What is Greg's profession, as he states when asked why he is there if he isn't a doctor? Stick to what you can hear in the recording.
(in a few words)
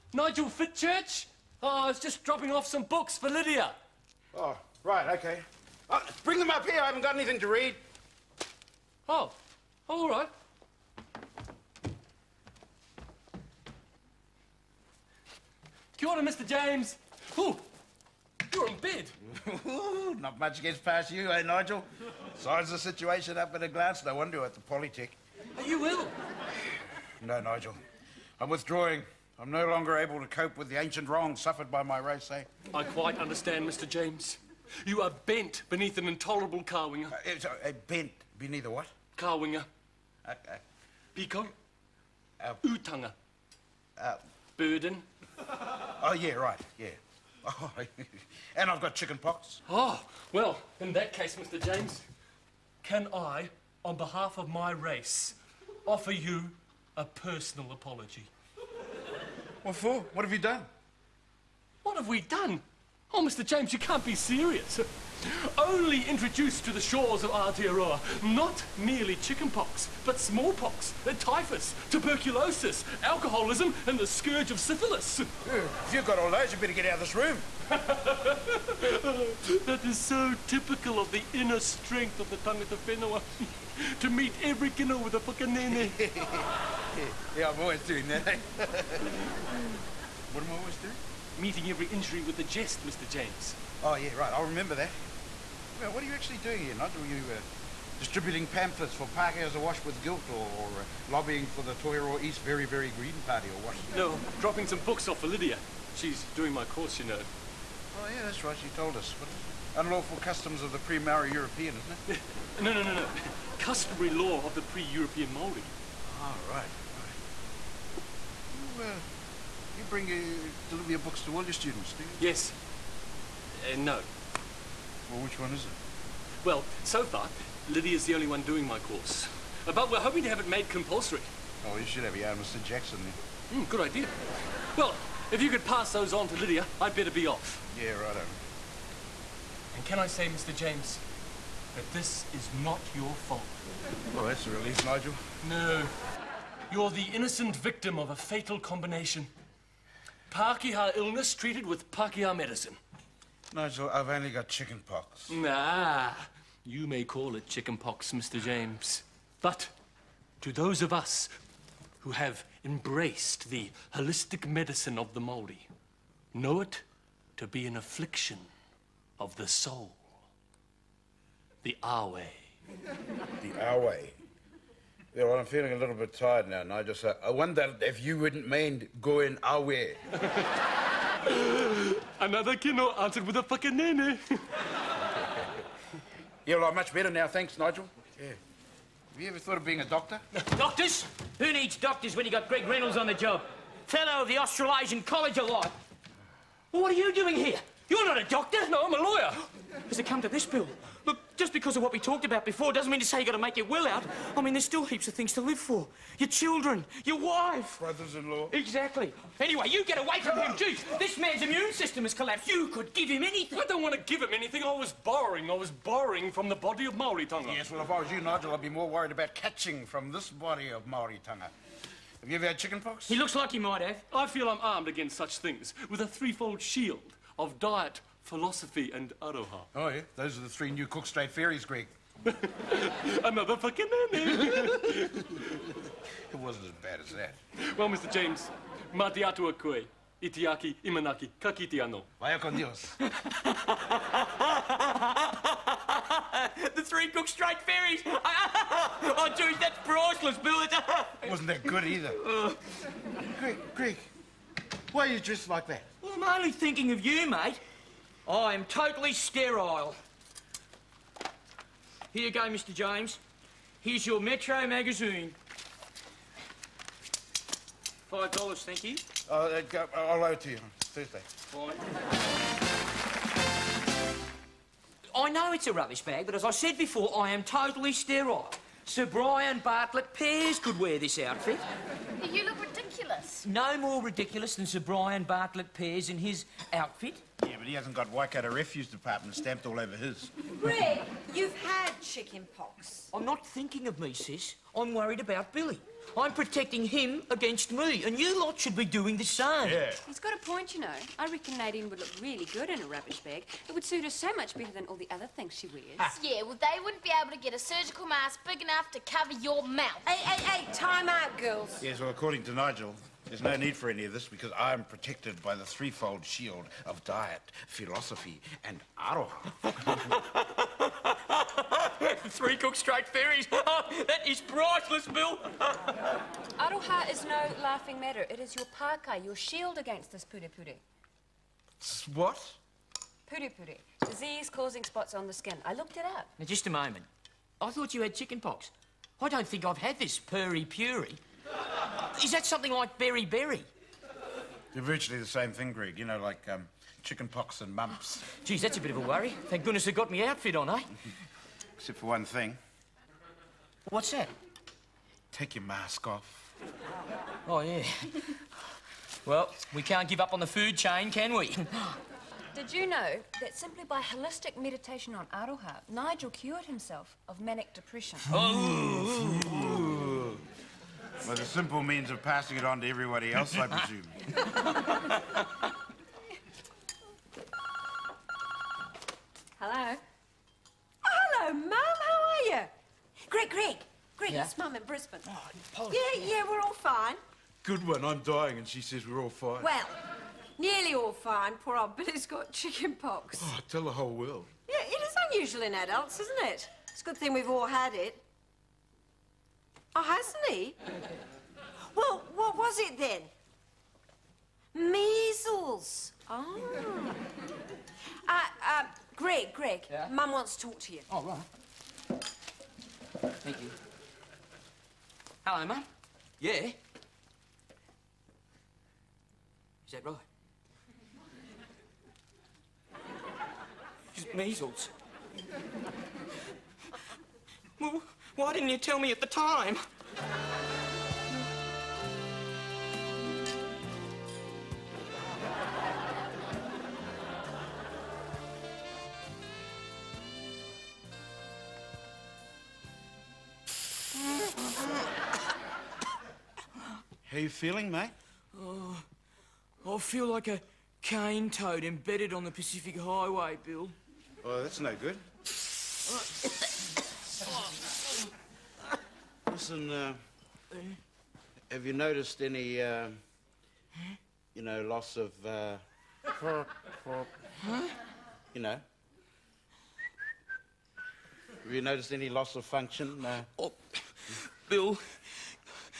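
Lawyer.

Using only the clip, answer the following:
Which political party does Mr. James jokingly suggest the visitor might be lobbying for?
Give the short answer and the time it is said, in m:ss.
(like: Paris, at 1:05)
Toiro East Very, Very Green Party, at 1:41.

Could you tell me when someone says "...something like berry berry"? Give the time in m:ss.
5:42.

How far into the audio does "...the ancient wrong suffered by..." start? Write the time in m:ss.
0:30.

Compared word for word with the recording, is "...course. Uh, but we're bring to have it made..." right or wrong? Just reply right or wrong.
wrong.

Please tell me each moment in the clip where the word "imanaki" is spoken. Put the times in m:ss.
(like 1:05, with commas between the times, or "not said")
4:00.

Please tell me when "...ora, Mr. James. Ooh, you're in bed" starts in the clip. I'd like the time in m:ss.
0:16.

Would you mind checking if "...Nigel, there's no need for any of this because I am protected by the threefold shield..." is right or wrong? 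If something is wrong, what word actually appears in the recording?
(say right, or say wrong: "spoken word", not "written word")
right.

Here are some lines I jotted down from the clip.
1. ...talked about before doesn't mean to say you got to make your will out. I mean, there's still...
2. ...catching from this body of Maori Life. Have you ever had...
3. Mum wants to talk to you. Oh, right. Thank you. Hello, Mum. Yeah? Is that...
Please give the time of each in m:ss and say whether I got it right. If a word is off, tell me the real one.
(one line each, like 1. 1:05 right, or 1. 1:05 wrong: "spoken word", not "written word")
1. 3:21 right
2. 3:39 wrong: "Tonga", not "Life"
3. 6:50 right.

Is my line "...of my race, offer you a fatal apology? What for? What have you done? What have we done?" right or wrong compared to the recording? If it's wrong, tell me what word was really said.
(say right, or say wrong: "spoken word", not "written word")
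wrong: "personal", not "fatal".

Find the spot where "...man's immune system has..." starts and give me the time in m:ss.
3:31.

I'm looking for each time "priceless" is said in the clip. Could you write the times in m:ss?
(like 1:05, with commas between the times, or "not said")
4:09, 5:24.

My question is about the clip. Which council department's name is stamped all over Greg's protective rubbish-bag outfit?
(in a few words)
Waikato Refuse Department.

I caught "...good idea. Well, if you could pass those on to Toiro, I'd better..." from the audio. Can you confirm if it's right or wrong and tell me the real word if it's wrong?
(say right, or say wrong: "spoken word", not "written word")
wrong: "Lydia", not "Toiro".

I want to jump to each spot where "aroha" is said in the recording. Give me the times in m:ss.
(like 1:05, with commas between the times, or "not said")
3:49, 5:18, 5:26, 6:05.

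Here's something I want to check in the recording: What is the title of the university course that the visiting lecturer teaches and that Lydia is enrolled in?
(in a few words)
Customary law of the pre-European Maori.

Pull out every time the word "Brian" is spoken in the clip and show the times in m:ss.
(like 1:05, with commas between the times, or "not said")
4:39, 4:44.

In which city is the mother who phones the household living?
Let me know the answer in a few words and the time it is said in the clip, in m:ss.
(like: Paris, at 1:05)
Brisbane, at 6:24.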